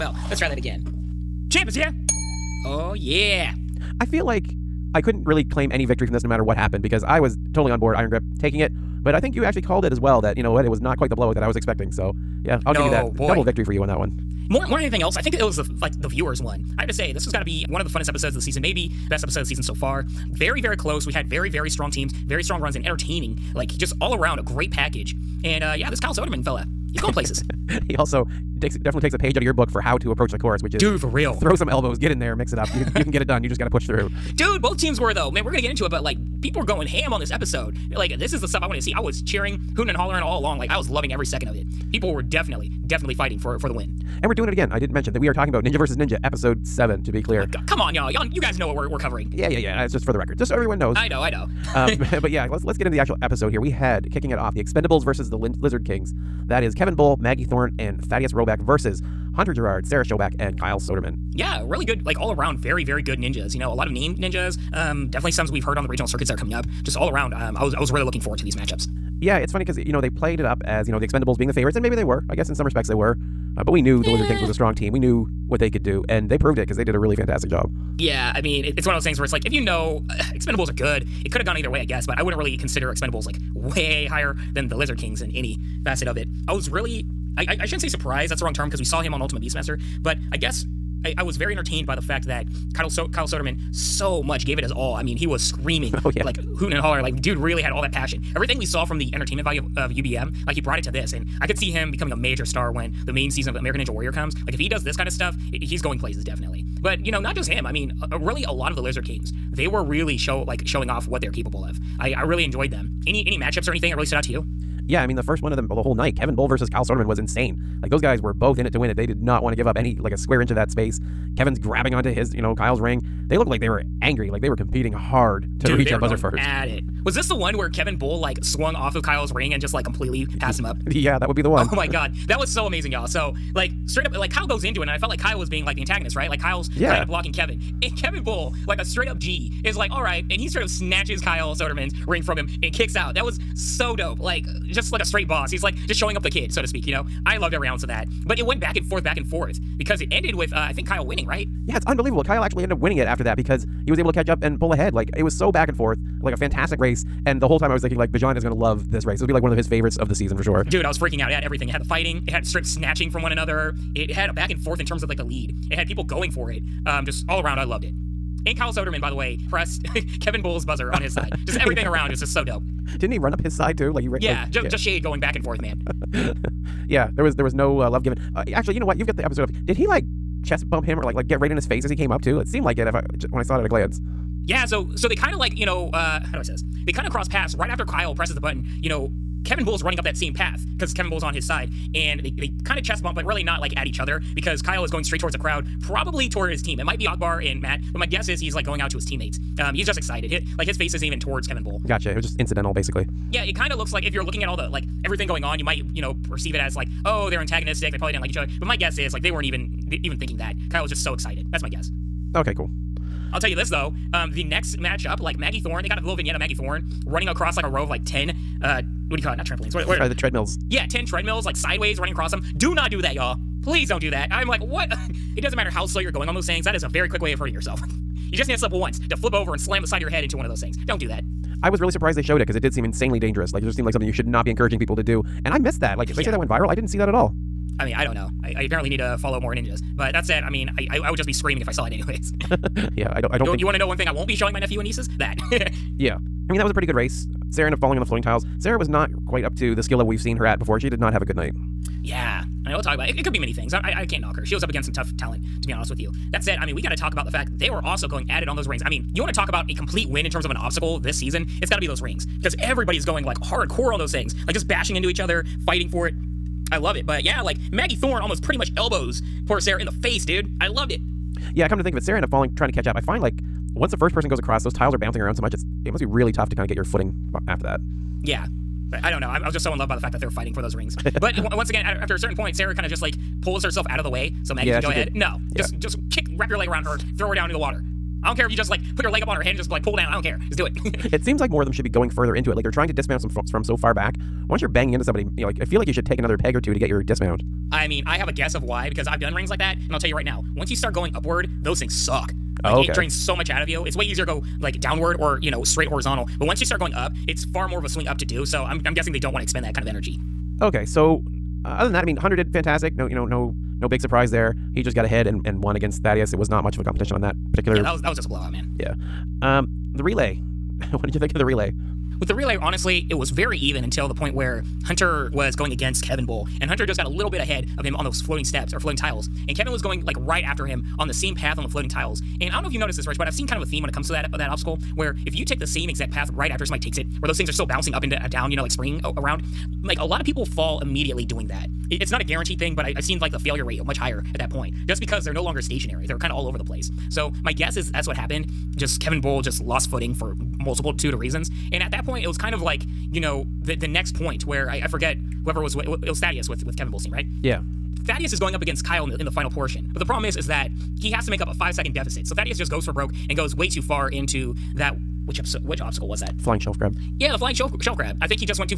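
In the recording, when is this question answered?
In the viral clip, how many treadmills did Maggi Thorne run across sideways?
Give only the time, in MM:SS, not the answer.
03:40.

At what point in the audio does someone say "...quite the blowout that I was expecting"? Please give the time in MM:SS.
00:10.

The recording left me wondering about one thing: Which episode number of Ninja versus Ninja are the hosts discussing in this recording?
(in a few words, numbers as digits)
7.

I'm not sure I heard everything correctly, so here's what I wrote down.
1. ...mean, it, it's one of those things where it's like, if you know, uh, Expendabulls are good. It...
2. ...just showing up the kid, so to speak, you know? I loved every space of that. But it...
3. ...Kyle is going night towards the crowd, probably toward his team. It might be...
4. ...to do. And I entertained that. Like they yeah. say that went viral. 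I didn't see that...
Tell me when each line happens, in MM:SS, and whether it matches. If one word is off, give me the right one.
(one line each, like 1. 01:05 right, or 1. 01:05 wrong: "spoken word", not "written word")
1. 01:18 right
2. 02:25 wrong: "ounce", not "space"
3. 03:14 wrong: "straight", not "night"
4. 03:54 wrong: "missed", not "entertained".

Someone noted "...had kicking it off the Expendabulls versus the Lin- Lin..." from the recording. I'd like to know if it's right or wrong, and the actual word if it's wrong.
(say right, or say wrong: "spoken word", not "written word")
wrong: "Lizard", not "Lin".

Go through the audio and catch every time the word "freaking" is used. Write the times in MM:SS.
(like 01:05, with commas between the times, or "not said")
02:40.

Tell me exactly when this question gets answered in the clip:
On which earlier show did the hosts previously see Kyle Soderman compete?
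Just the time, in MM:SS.
01:29.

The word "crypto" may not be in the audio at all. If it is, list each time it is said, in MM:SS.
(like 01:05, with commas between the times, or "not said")
not said.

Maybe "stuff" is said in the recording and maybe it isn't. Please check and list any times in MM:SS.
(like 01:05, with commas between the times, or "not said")
00:38, 01:45.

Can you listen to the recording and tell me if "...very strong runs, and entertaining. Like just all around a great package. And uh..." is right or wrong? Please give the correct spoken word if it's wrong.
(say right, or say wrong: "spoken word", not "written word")
right.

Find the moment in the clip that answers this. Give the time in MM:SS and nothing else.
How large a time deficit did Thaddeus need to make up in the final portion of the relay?
06:01.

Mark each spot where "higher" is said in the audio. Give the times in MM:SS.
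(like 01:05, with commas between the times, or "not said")
01:24, 05:43.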